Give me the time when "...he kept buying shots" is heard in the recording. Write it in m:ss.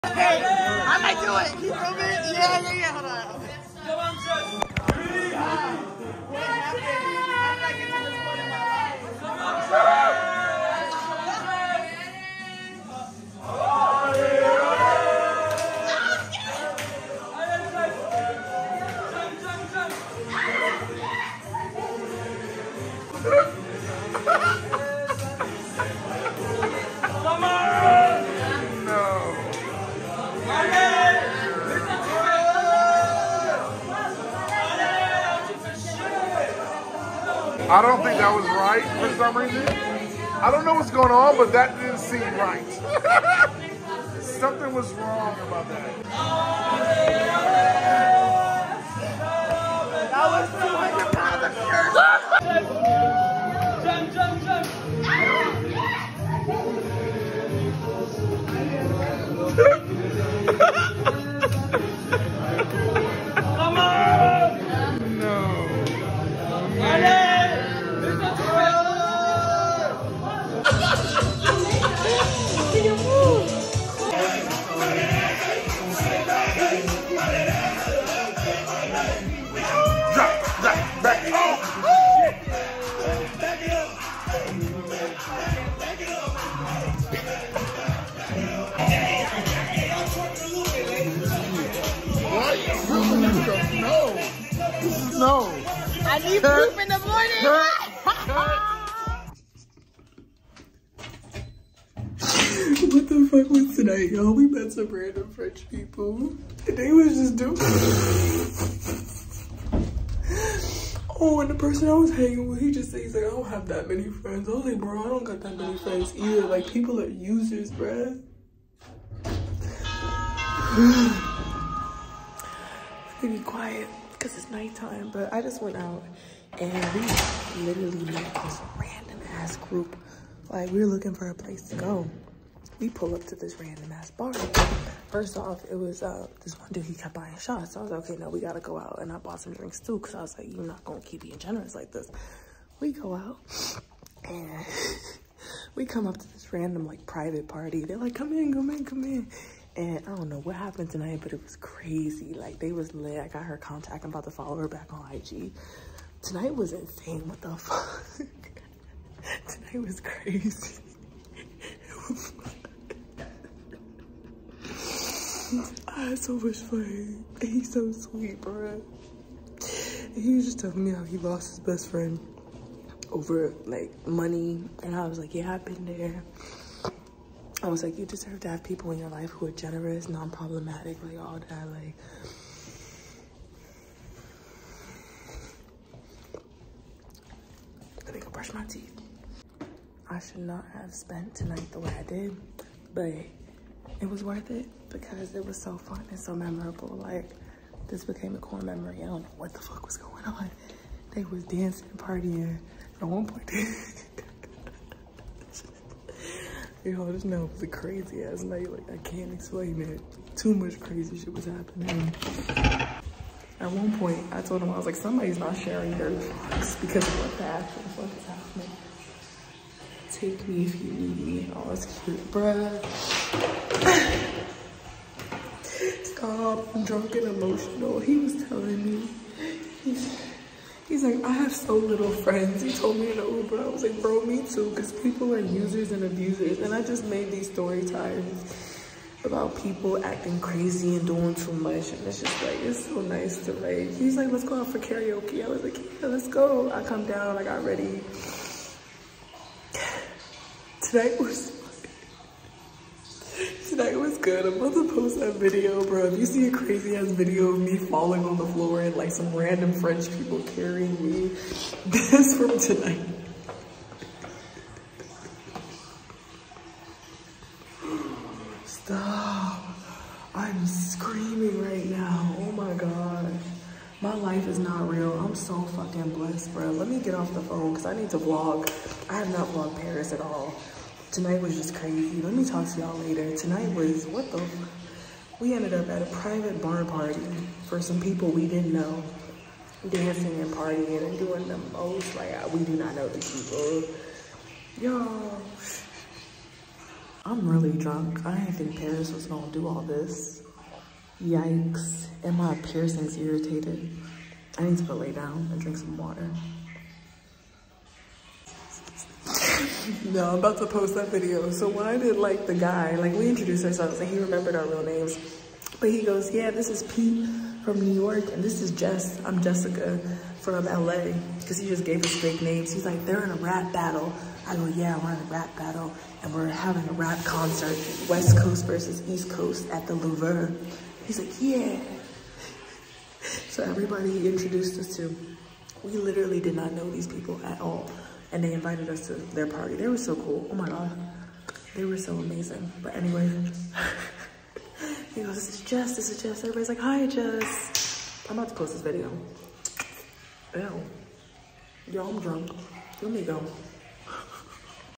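2:16.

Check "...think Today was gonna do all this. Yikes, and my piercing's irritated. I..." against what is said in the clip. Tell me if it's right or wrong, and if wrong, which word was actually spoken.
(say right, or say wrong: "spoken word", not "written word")
wrong: "Paris", not "Today".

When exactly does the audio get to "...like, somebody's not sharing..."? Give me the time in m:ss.
3:34.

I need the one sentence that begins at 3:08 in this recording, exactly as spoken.
Let me i brush my teeth.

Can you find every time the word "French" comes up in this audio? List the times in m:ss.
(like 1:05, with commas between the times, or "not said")
1:45, 4:19.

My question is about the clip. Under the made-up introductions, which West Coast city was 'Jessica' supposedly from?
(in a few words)
LA.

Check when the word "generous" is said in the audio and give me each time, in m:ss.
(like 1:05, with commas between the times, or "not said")
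2:21, 2:59.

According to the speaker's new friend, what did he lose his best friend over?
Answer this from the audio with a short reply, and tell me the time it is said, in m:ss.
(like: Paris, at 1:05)
Money, at 2:54.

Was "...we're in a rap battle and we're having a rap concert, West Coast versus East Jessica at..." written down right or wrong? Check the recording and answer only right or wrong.
wrong.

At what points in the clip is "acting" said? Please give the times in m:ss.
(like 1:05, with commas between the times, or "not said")
4:00.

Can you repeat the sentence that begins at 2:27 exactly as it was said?
They're like, come in, come in, come in.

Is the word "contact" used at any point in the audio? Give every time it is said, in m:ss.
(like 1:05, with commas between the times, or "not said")
2:33.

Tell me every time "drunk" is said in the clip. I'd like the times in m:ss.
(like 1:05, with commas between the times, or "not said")
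3:46, 4:57, 5:52.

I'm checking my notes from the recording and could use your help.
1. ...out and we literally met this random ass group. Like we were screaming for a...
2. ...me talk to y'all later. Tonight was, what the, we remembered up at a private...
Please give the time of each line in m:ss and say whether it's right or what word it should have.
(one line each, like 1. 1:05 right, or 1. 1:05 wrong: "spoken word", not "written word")
1. 2:05 wrong: "looking", not "screaming"
2. 4:42 wrong: "ended", not "remembered".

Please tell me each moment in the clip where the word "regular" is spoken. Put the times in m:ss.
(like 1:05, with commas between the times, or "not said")
not said.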